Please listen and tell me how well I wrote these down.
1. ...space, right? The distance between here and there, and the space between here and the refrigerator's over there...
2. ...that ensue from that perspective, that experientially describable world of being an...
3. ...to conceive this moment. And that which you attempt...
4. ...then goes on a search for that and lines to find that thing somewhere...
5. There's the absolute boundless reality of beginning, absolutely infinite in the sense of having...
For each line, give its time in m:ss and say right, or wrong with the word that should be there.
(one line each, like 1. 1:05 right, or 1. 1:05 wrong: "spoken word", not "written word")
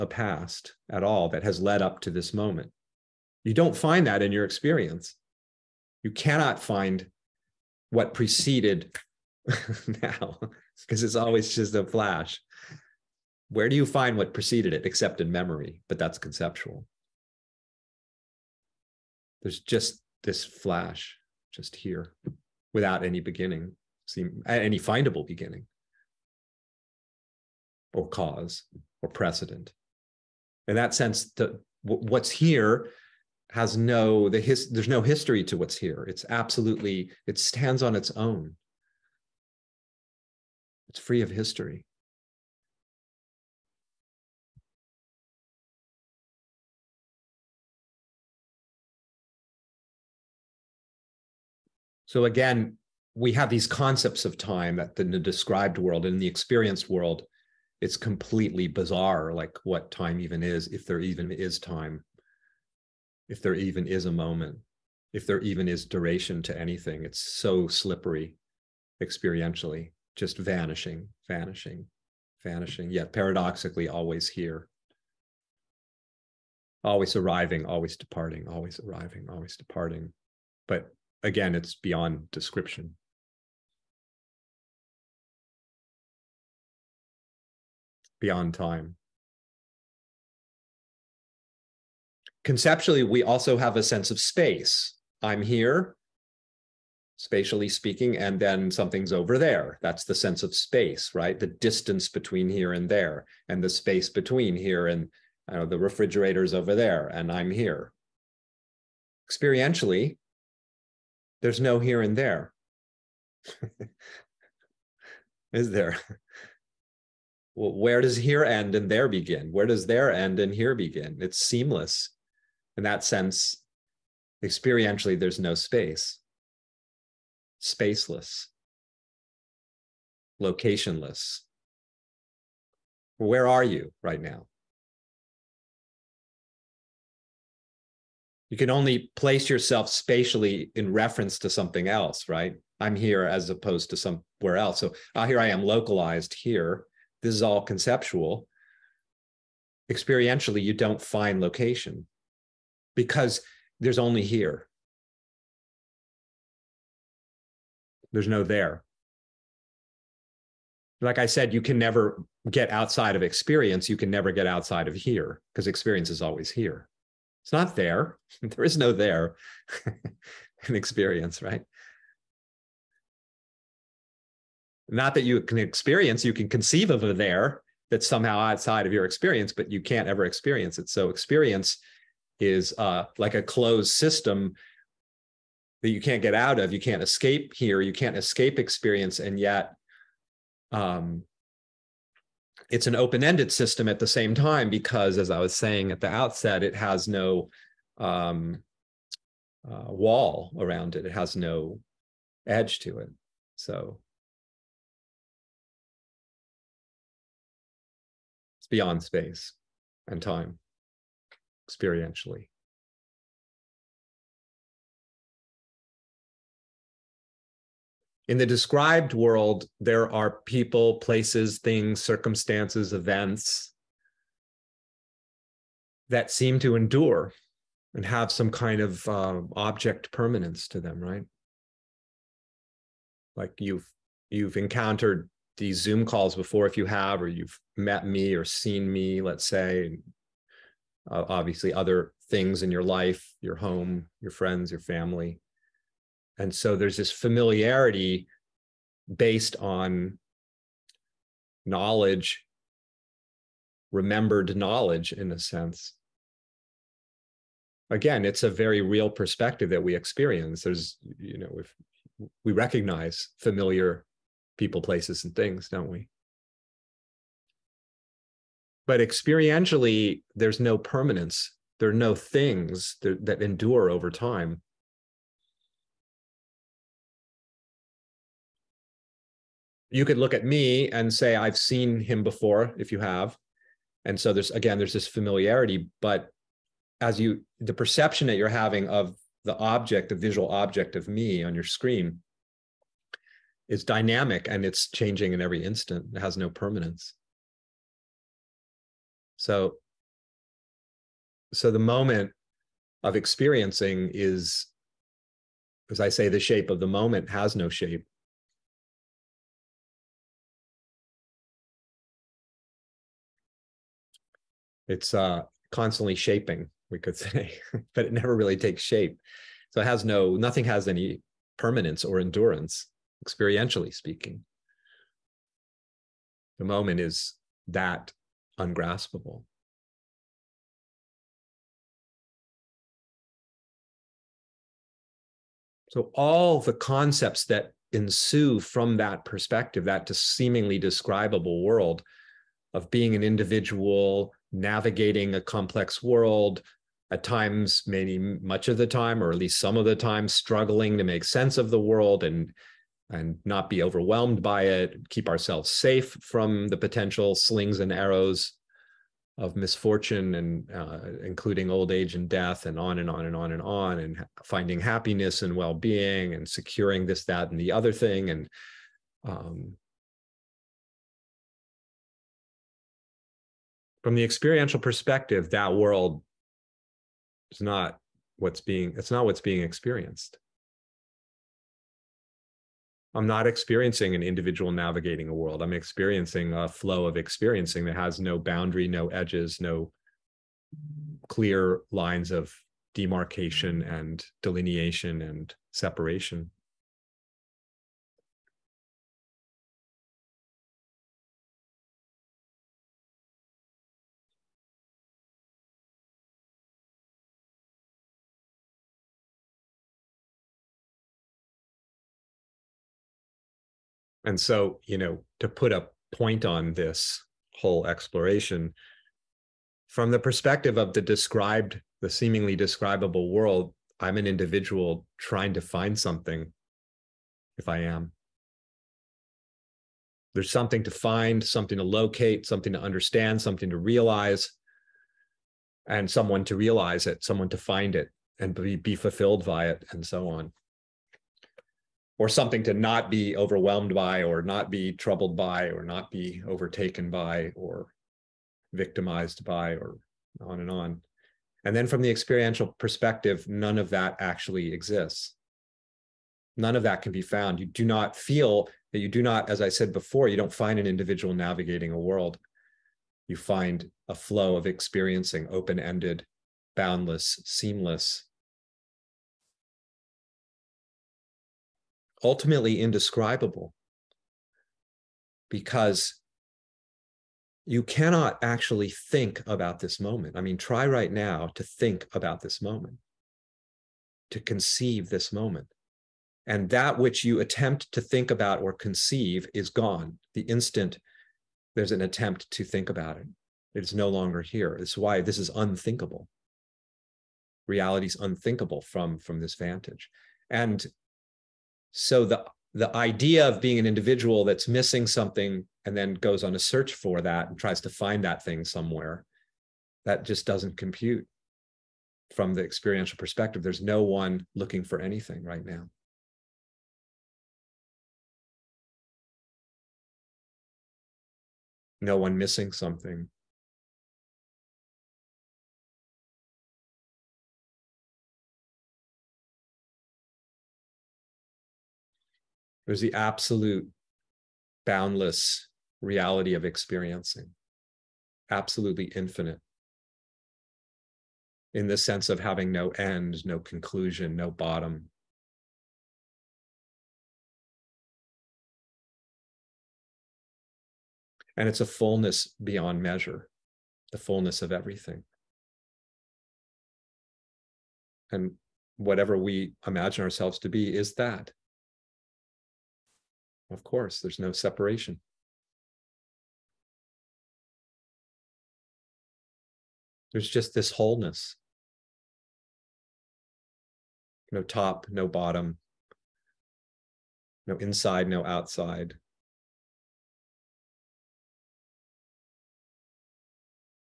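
1. 1:40 right
2. 5:37 wrong: "seemingly", not "experientially"
3. 8:04 right
4. 8:25 wrong: "tries", not "lines"
5. 8:52 wrong: "experiencing", not "beginning".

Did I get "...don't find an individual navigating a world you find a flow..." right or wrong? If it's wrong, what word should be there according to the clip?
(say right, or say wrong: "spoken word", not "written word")
right.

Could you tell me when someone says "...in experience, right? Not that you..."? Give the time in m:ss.
2:50.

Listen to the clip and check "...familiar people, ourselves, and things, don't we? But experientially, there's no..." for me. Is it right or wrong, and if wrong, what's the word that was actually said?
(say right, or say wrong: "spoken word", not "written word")
wrong: "places", not "ourselves".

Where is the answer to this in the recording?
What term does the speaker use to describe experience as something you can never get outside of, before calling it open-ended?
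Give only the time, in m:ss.
3:03.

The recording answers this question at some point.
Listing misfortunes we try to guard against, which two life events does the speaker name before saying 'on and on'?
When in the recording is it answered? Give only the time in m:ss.
6:01.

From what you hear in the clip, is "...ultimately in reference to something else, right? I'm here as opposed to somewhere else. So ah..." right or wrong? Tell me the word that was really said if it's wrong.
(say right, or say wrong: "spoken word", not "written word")
wrong: "spatially", not "ultimately".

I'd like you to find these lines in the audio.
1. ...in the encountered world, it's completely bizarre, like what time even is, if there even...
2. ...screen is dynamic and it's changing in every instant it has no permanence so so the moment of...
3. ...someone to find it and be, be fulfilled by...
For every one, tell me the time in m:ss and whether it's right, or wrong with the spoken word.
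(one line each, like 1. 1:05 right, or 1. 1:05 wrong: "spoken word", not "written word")
1. 0:56 wrong: "experienced", not "encountered"
2. 4:51 right
3. 7:17 right.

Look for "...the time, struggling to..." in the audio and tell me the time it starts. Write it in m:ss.
5:49.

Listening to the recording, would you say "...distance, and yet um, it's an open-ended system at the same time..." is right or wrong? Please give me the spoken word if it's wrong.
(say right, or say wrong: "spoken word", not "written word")
wrong: "experience", not "distance".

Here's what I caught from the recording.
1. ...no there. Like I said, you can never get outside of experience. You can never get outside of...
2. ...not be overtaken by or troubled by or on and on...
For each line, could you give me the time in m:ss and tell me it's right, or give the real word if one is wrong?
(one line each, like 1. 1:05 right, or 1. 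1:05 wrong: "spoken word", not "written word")
1. 2:38 right
2. 7:25 wrong: "victimized", not "troubled".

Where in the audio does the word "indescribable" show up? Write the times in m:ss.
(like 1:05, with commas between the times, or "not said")
7:52.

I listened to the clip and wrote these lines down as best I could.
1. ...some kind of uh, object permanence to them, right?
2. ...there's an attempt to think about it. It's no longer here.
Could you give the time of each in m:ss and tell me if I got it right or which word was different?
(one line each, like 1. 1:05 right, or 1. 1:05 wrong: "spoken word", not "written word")
1. 3:48 right
2. 8:11 right.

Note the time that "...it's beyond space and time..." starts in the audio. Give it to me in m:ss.
3:28.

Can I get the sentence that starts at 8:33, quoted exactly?
There's no one looking for anything right now.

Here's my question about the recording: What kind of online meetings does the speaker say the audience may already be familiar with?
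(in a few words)
Zoom calls.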